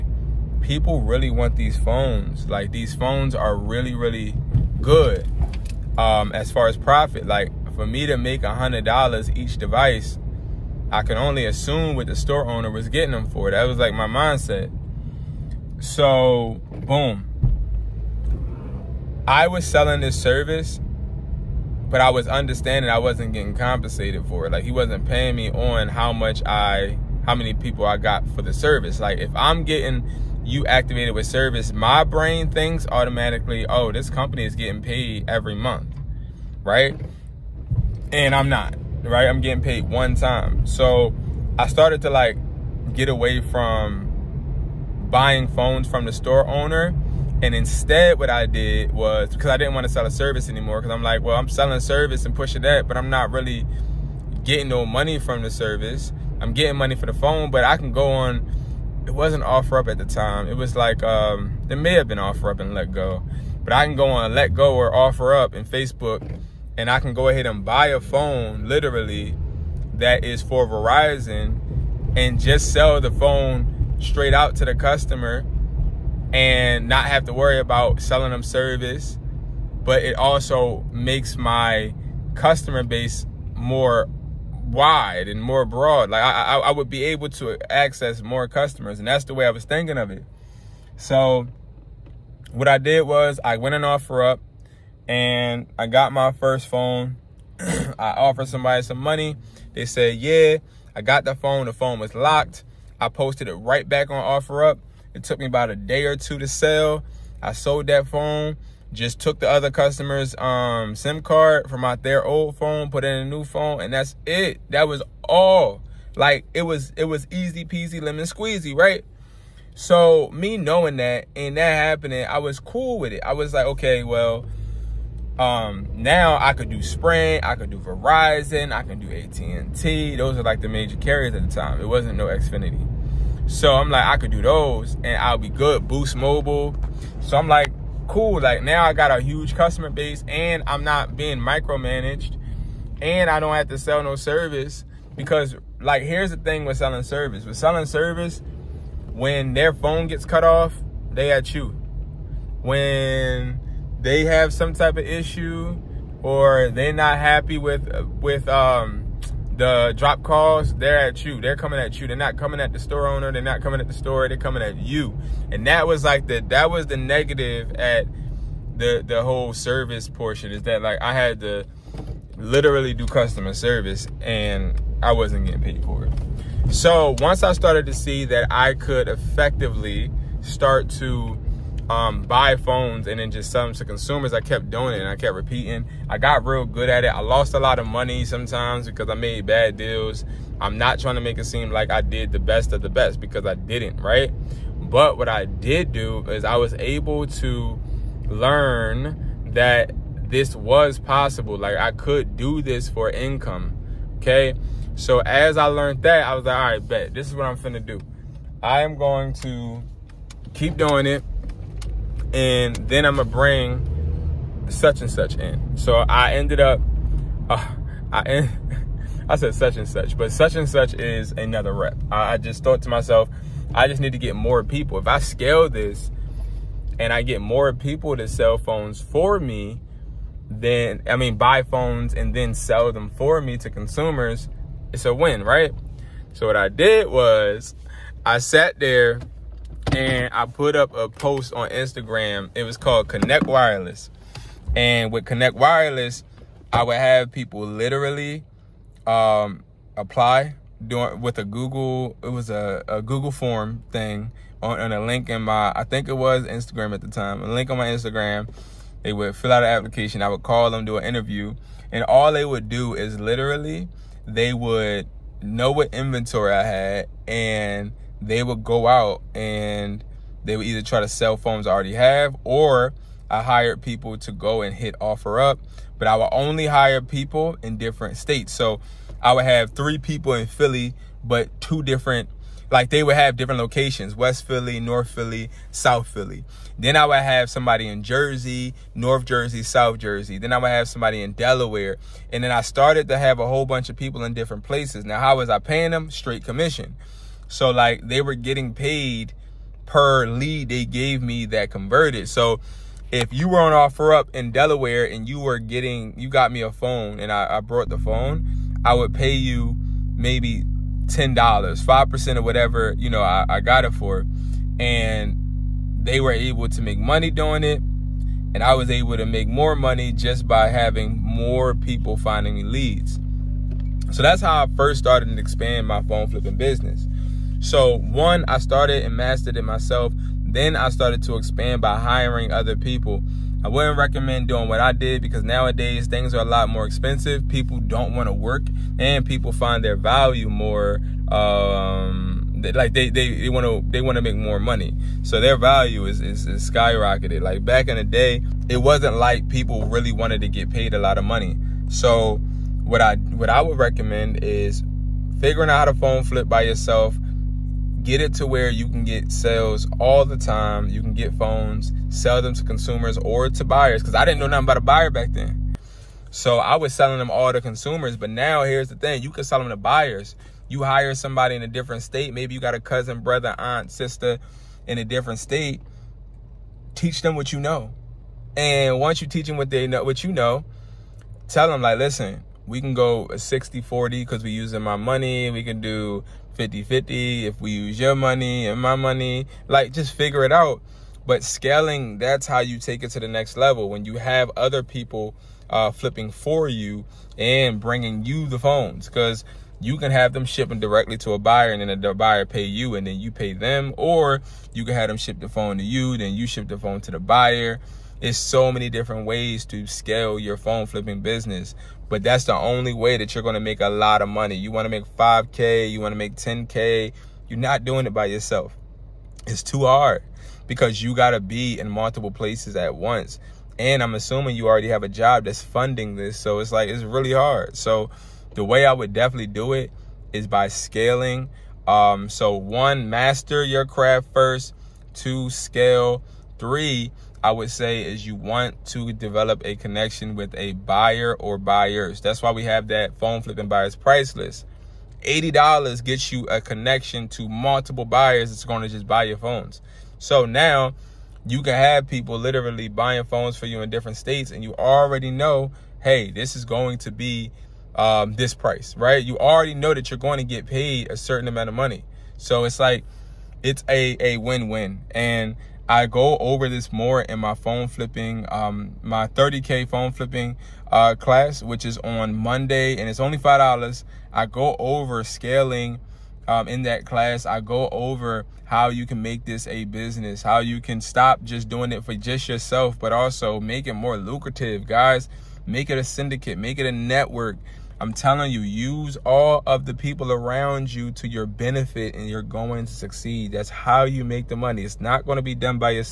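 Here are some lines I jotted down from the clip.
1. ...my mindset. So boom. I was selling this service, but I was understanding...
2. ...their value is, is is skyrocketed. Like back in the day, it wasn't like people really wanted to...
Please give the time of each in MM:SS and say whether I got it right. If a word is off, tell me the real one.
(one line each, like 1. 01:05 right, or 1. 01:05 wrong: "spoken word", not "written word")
1. 00:13 right
2. 05:45 right.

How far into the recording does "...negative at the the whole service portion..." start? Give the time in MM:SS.
02:46.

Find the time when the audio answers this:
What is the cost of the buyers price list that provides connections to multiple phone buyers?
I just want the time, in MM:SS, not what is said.
07:25.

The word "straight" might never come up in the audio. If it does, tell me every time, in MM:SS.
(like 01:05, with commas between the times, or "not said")
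01:13, 04:56.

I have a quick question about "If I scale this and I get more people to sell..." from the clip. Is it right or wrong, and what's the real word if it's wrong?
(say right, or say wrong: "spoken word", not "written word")
right.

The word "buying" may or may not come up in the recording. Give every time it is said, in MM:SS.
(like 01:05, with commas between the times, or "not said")
00:45, 07:32.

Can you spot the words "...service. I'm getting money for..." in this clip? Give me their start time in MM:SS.
00:55.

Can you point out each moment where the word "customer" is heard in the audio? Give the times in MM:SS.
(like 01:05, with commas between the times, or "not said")
01:14, 01:22, 01:28, 01:49, 02:19, 02:53.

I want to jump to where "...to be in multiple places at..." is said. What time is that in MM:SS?
07:01.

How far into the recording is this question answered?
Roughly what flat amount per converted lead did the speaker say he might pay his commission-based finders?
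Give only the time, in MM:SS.
05:11.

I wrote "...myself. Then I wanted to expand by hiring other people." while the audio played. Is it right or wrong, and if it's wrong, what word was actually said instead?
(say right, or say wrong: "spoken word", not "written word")
wrong: "started", not "wanted".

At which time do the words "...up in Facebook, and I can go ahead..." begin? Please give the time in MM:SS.
01:05.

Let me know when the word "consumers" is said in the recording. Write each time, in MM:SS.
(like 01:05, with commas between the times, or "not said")
03:03, 03:53, 06:02, 06:07.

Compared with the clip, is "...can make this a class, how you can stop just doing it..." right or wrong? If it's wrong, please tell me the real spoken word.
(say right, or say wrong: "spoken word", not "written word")
wrong: "business", not "class".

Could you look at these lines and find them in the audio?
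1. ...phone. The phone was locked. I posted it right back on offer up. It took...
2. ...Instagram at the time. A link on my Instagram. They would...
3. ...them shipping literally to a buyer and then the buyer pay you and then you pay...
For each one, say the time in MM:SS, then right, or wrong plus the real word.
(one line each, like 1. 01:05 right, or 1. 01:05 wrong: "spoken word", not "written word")
1. 01:41 right
2. 04:16 right
3. 06:40 wrong: "directly", not "literally".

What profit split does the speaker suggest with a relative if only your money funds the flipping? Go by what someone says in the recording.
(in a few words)
60 40.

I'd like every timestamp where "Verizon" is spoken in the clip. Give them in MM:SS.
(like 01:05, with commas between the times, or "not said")
01:10, 02:07.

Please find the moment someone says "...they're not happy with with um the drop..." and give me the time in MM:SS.
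02:36.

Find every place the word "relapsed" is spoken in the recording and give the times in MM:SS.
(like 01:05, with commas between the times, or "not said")
not said.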